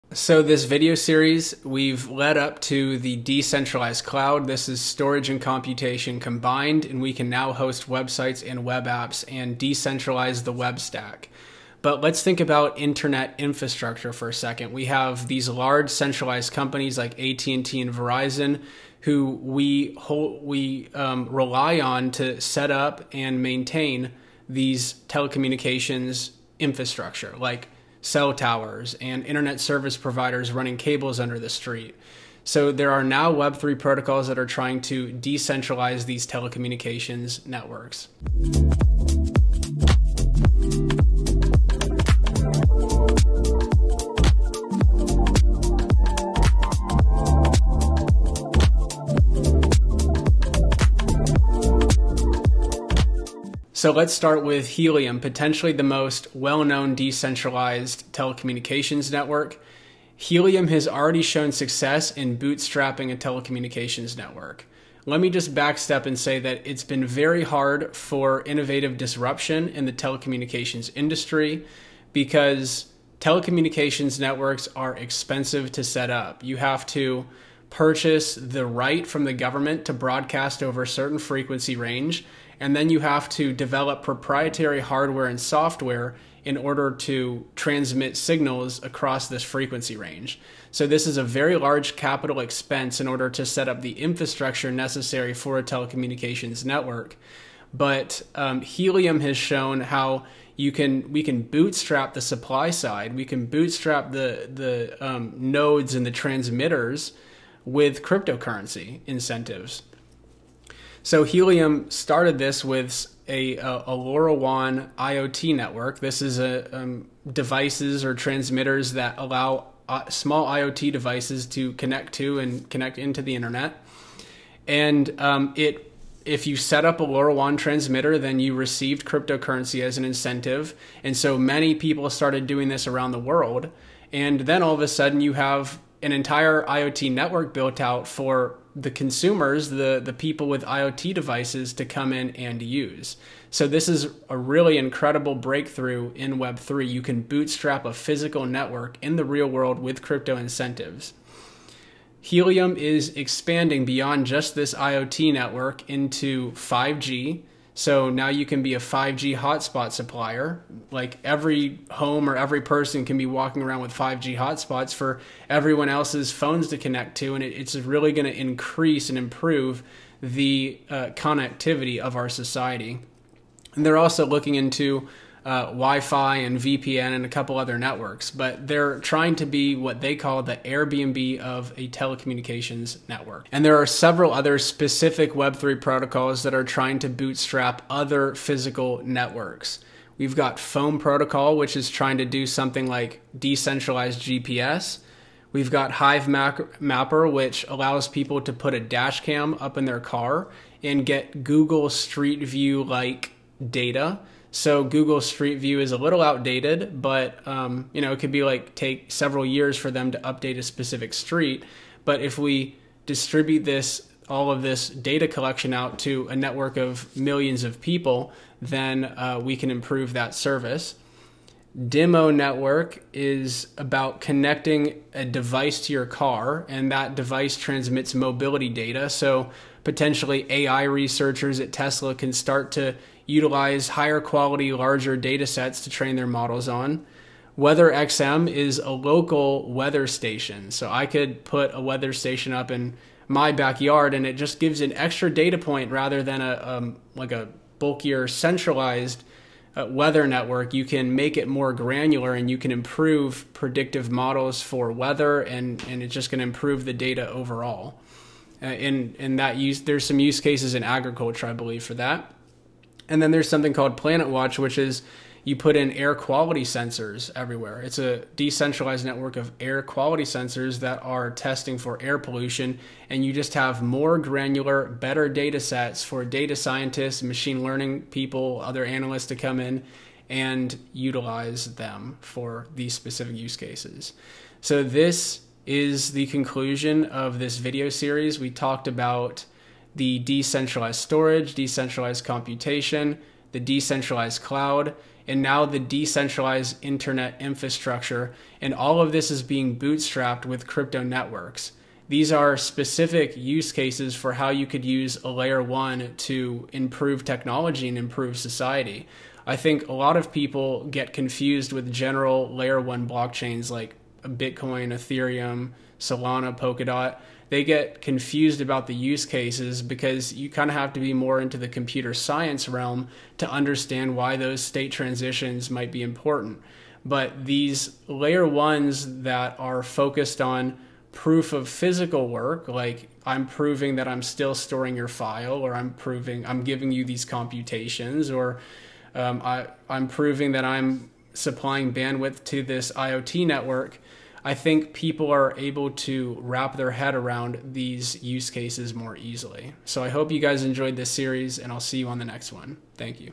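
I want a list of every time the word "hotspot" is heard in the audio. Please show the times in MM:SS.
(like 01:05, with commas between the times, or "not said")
02:39, 02:44.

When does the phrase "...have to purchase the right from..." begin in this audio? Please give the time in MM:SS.
01:16.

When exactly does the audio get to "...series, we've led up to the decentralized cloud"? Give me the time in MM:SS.
00:00.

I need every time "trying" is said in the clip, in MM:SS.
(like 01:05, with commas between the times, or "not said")
00:34, 02:58, 03:06, 03:11.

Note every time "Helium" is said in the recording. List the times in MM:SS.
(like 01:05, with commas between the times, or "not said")
00:54, 01:00, 01:38, 01:51, 02:32.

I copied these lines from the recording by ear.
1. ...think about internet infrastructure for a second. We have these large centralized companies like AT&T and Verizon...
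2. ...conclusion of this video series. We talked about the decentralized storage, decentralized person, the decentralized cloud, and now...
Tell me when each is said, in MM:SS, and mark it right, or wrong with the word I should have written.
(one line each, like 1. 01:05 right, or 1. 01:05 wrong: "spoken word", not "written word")
1. 00:12 right
2. 04:46 wrong: "computation", not "person".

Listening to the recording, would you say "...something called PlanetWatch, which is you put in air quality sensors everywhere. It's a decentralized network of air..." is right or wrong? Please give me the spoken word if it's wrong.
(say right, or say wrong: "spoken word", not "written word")
right.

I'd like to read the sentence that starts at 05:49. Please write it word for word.
So I hope you guys enjoyed this series, and I'll see you on the next one.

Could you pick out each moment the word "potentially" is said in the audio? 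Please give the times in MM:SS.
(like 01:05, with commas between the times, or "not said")
00:55, 03:49.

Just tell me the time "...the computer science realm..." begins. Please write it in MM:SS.
05:21.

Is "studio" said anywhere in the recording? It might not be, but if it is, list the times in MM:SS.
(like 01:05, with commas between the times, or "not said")
not said.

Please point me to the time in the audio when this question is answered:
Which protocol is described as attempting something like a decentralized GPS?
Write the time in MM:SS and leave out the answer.
03:10.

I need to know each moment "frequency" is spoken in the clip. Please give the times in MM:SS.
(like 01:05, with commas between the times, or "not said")
01:21, 01:29.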